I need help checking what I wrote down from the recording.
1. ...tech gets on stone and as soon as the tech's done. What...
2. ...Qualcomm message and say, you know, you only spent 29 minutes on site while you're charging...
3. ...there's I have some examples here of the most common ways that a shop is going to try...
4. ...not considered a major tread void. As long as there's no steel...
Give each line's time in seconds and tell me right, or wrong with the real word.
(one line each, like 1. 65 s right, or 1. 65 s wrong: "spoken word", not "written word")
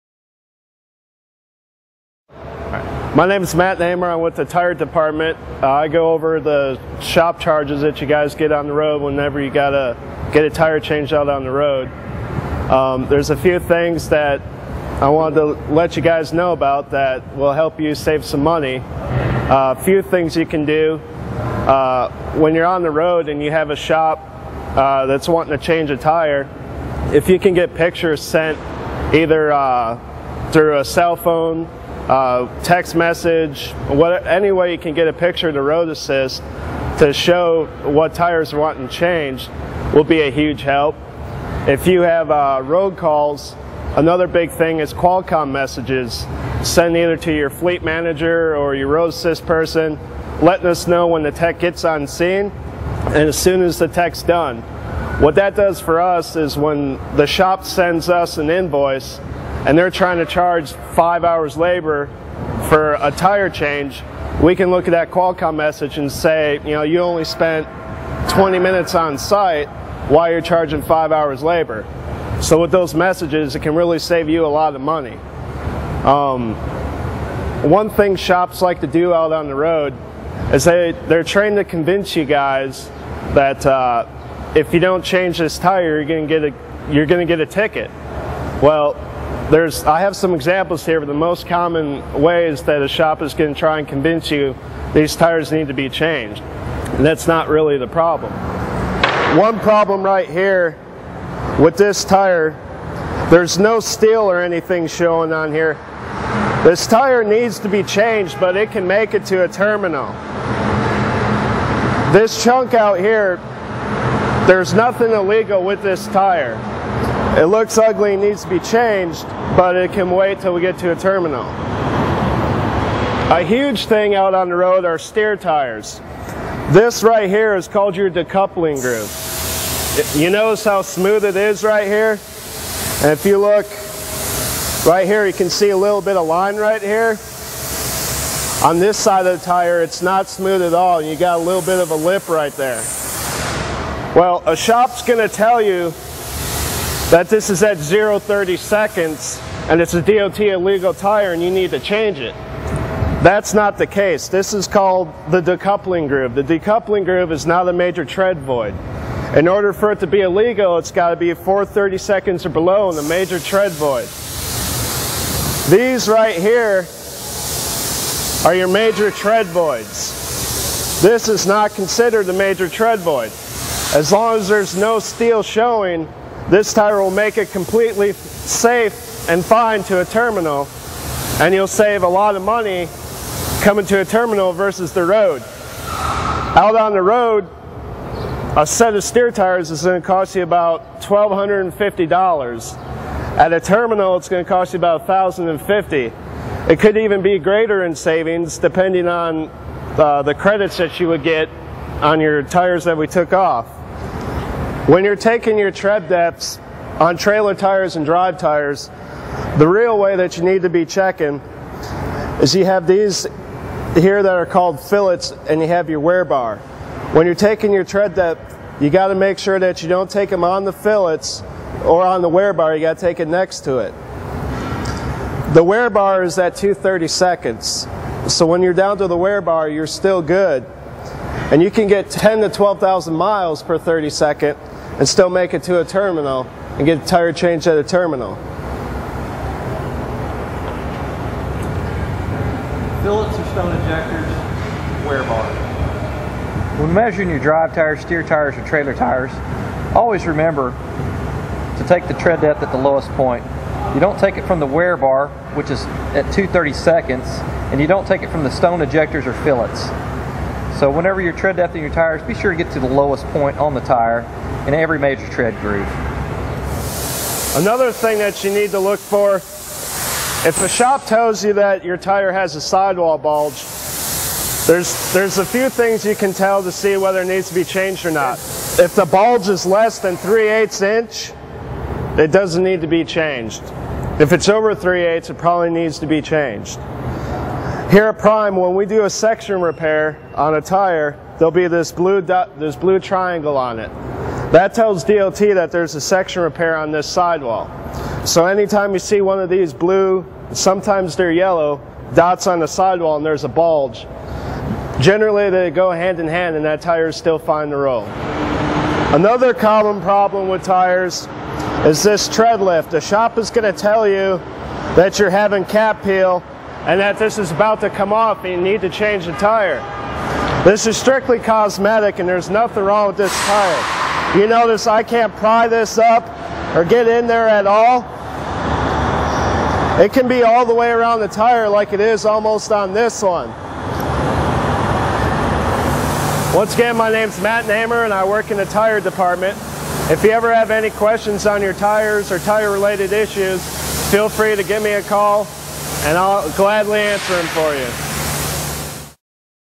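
1. 51 s wrong: "scene", not "stone"
2. 65 s wrong: "20", not "29"
3. 89 s right
4. 171 s right.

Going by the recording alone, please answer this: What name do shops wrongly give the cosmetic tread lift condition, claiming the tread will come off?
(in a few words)
cap peel.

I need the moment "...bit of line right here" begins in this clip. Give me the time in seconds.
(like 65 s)
136 s.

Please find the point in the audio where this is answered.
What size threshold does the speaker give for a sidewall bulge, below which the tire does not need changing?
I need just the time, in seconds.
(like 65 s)
280 s.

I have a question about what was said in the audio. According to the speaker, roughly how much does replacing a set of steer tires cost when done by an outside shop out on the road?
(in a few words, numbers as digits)
$1,250.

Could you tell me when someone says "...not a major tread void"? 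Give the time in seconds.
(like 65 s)
157 s.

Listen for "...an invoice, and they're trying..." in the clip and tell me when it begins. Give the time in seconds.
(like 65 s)
58 s.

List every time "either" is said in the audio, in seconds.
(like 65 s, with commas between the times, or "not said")
29 s, 46 s.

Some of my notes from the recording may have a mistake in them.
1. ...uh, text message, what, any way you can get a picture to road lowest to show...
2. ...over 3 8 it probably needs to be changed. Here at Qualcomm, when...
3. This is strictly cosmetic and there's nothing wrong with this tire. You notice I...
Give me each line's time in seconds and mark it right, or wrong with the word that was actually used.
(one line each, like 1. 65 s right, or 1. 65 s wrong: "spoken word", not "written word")
1. 32 s wrong: "assist", not "lowest"
2. 284 s wrong: "Prime", not "Qualcomm"
3. 320 s right.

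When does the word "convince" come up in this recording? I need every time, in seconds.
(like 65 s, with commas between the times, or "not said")
81 s, 93 s.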